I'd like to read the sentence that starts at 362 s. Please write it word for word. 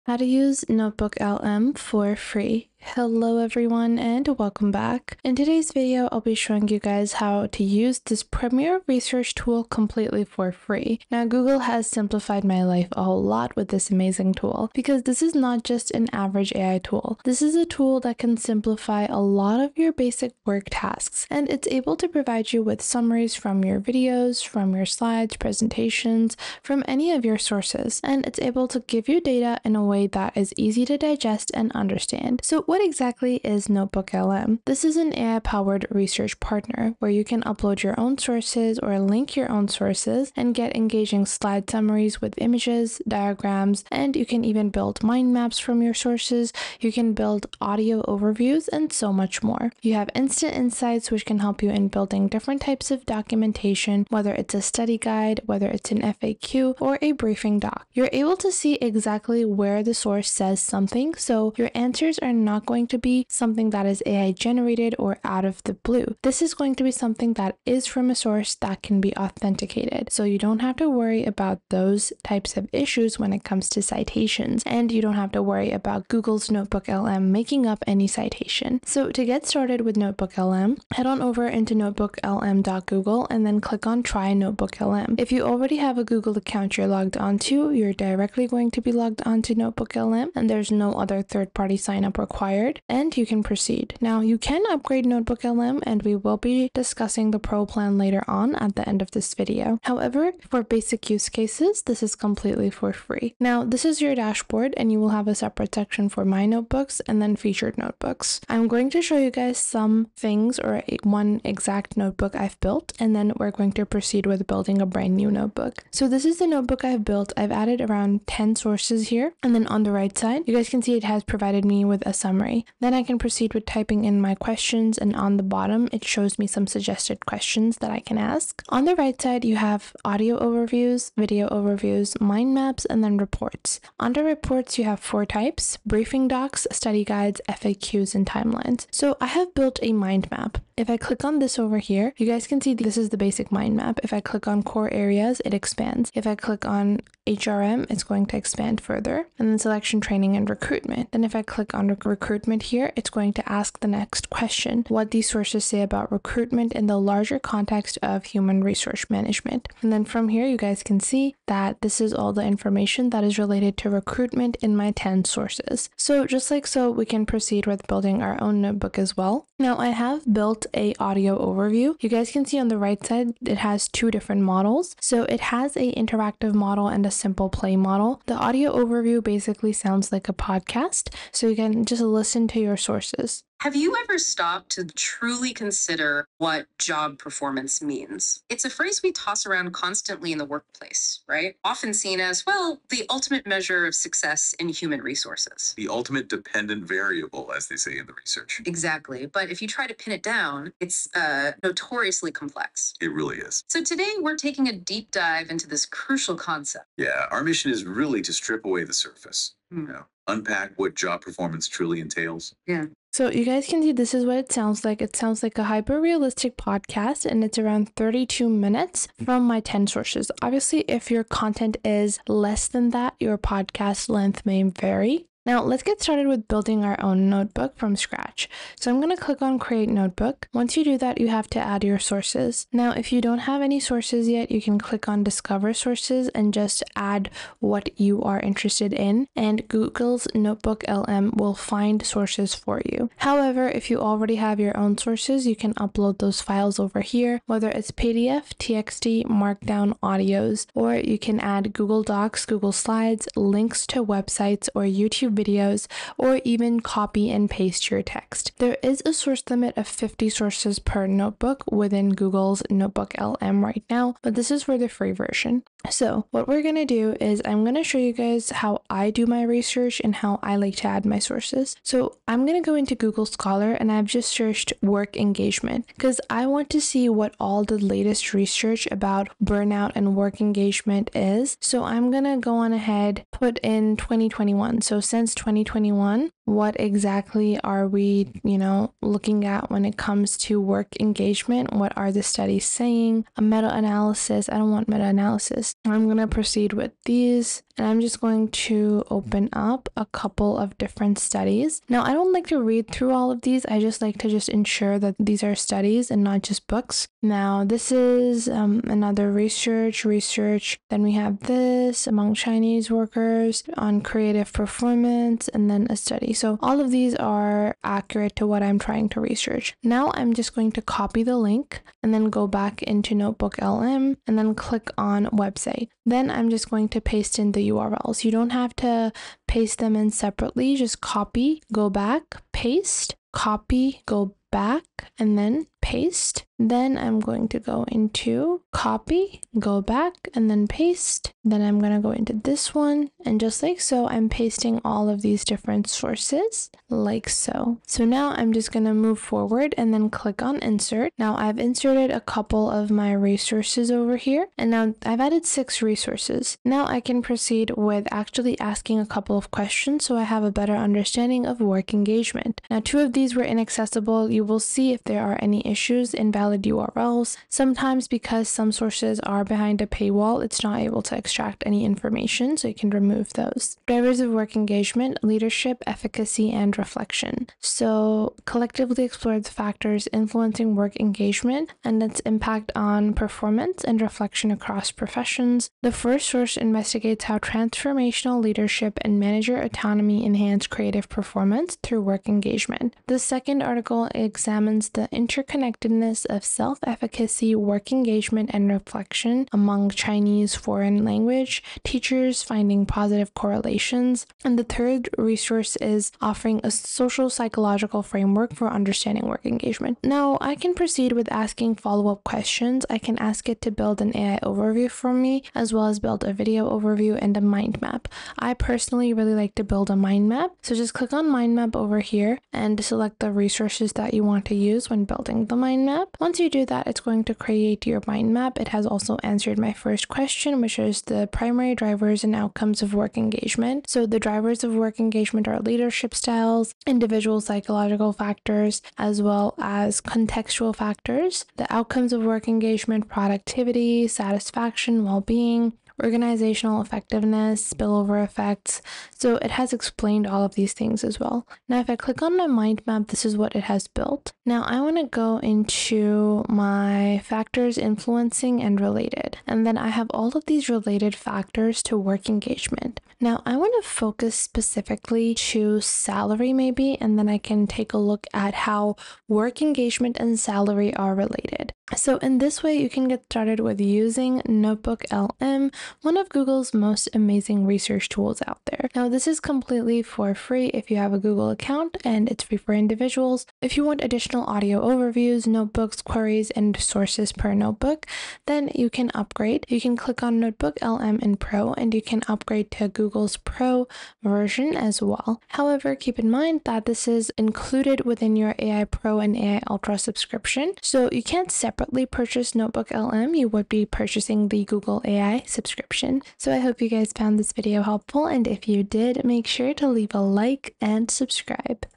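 Now two of these were inaccessible.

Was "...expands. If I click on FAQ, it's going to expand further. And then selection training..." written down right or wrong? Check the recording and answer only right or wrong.
wrong.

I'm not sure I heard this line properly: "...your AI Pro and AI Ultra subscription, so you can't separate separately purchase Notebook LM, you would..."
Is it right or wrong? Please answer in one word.
right.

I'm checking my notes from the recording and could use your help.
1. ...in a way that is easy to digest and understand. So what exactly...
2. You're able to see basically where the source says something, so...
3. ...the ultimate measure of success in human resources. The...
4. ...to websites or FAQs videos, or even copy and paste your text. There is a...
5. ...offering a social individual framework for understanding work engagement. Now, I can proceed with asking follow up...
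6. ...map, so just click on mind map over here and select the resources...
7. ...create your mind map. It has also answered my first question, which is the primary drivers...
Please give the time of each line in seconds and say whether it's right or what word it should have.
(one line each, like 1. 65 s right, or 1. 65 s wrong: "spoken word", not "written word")
1. 29 s right
2. 57 s wrong: "exactly", not "basically"
3. 192 s right
4. 253 s wrong: "YouTube", not "FAQs"
5. 406 s wrong: "psychological", not "individual"
6. 420 s right
7. 427 s right.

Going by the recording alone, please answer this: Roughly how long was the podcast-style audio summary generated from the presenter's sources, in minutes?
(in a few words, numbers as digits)
32 minutes.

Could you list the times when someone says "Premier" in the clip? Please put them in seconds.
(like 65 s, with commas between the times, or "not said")
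8 s.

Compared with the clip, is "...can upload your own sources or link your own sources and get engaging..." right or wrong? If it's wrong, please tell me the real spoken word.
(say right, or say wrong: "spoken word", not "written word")
right.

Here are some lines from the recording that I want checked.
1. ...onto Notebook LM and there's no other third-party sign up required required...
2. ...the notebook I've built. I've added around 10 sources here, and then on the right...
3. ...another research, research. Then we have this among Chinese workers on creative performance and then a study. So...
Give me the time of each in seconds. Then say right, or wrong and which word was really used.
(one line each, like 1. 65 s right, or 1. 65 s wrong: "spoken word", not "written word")
1. 89 s right
2. 116 s right
3. 308 s right.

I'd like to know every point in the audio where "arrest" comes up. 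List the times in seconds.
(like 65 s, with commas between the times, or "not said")
not said.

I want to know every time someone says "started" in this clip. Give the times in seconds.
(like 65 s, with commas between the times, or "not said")
79 s, 226 s, 473 s.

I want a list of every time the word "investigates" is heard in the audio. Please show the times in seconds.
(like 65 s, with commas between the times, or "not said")
386 s.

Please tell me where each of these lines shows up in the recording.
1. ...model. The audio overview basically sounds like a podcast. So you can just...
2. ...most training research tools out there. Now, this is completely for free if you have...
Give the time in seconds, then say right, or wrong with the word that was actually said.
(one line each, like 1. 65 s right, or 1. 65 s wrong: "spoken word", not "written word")
1. 177 s right
2. 476 s wrong: "amazing", not "training".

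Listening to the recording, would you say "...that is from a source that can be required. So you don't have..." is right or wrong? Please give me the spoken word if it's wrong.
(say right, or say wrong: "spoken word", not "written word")
wrong: "authenticated", not "required".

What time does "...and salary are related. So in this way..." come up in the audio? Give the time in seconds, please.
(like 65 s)
470 s.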